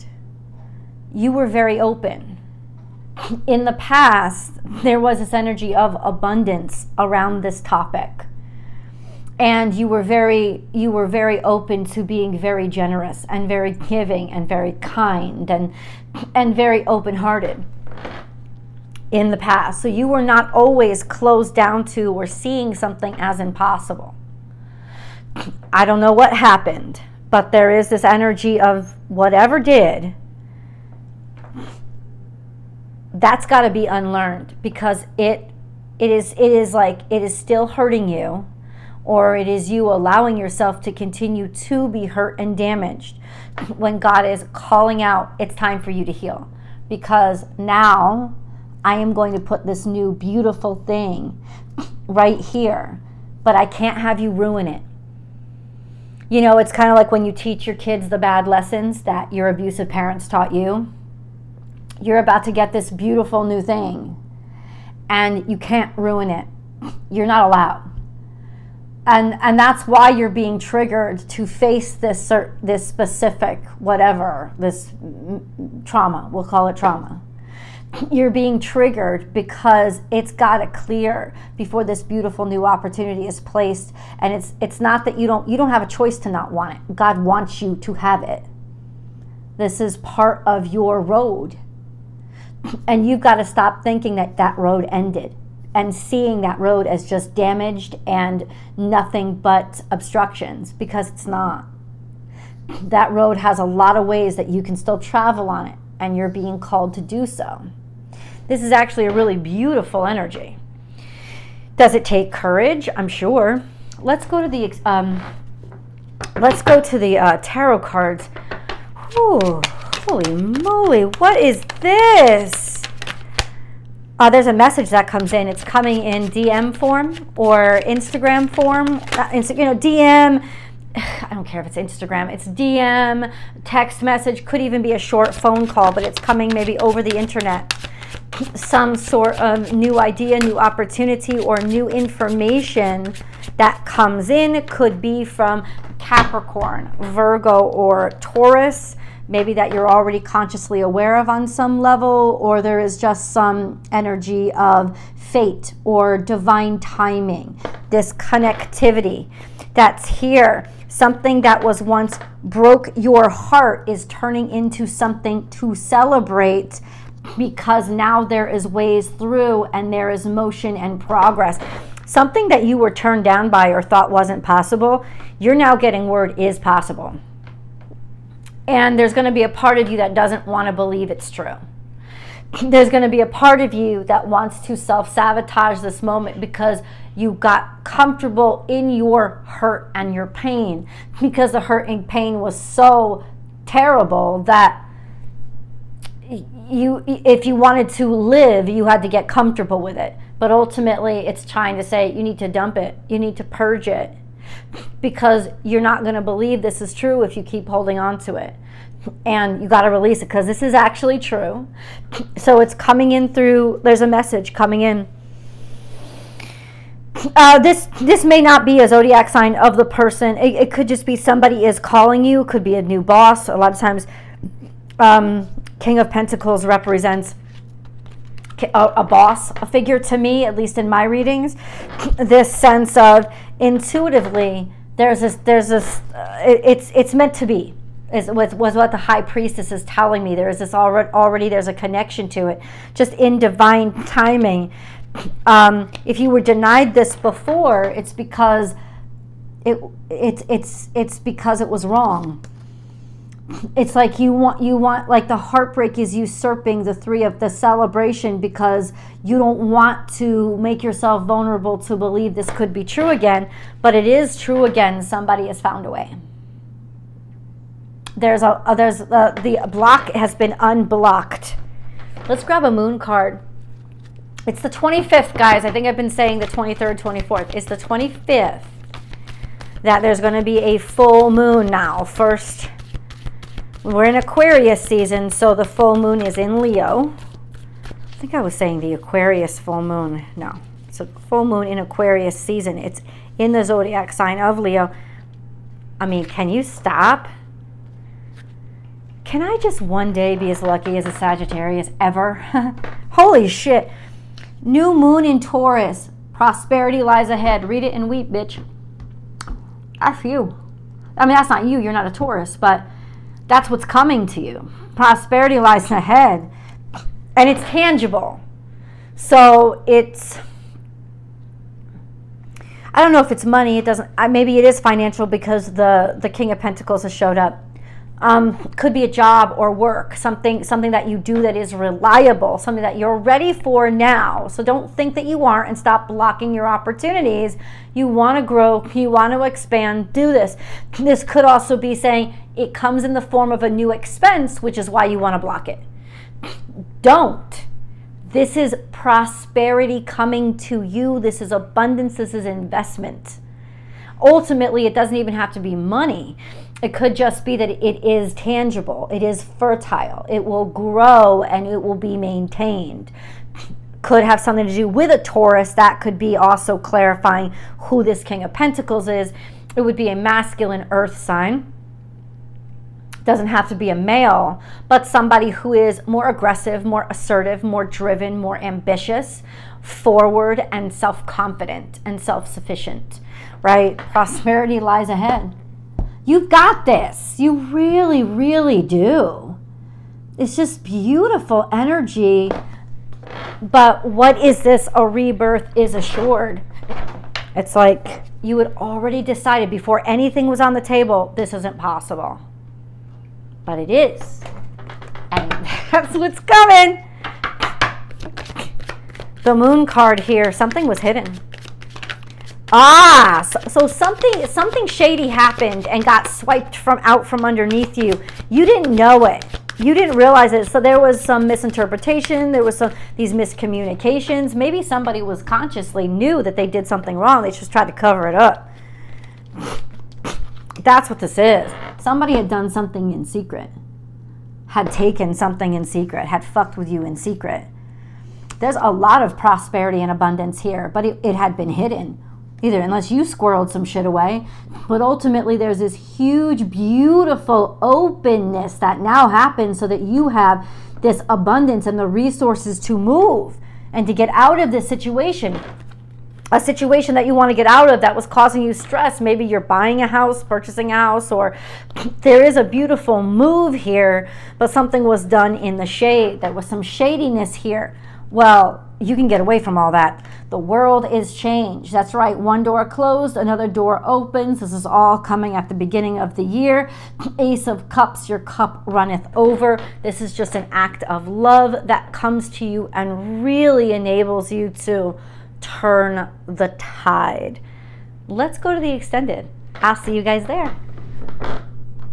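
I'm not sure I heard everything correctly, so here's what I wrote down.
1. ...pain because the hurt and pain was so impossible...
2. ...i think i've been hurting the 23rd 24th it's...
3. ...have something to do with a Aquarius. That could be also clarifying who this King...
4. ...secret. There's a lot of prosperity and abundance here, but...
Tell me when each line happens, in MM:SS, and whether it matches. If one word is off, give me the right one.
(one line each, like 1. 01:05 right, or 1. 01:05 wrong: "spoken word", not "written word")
1. 03:10 wrong: "terrible", not "impossible"
2. 04:35 wrong: "saying", not "hurting"
3. 06:04 wrong: "Taurus", not "Aquarius"
4. 07:17 right.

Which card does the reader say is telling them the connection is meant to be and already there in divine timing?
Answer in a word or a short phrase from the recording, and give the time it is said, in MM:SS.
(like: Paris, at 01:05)
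The High Priestess, at 03:58.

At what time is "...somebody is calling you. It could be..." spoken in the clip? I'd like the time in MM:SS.
03:41.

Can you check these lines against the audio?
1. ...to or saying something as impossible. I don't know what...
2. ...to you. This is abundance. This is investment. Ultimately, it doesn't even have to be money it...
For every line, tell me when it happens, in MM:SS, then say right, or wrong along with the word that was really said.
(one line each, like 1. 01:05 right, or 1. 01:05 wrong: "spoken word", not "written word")
1. 00:21 wrong: "seeing", not "saying"
2. 05:50 right.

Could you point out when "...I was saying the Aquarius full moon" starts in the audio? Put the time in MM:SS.
04:48.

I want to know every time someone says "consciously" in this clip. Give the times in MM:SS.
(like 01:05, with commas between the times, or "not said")
02:30, 07:05.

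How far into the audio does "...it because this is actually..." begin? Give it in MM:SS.
03:30.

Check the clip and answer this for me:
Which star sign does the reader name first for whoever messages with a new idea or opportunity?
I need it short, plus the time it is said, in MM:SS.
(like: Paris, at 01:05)
Capricorn, at 02:25.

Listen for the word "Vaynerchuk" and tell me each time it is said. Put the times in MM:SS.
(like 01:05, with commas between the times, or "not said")
not said.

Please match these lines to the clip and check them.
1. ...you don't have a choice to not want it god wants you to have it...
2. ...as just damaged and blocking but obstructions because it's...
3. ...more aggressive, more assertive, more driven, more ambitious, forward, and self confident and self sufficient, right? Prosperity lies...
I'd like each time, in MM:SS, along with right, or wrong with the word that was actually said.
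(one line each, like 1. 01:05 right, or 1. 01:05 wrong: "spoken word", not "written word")
1. 01:25 right
2. 01:36 wrong: "nothing", not "blocking"
3. 06:16 right.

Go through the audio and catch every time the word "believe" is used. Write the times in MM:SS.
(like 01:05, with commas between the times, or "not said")
03:00, 03:26, 04:21.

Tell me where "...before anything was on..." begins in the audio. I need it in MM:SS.
06:39.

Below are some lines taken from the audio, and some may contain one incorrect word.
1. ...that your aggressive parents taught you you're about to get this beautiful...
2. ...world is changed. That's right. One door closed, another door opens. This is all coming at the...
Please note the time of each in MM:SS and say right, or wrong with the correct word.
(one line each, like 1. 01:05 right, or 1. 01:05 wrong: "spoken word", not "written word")
1. 00:59 wrong: "abusive", not "aggressive"
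2. 07:50 right.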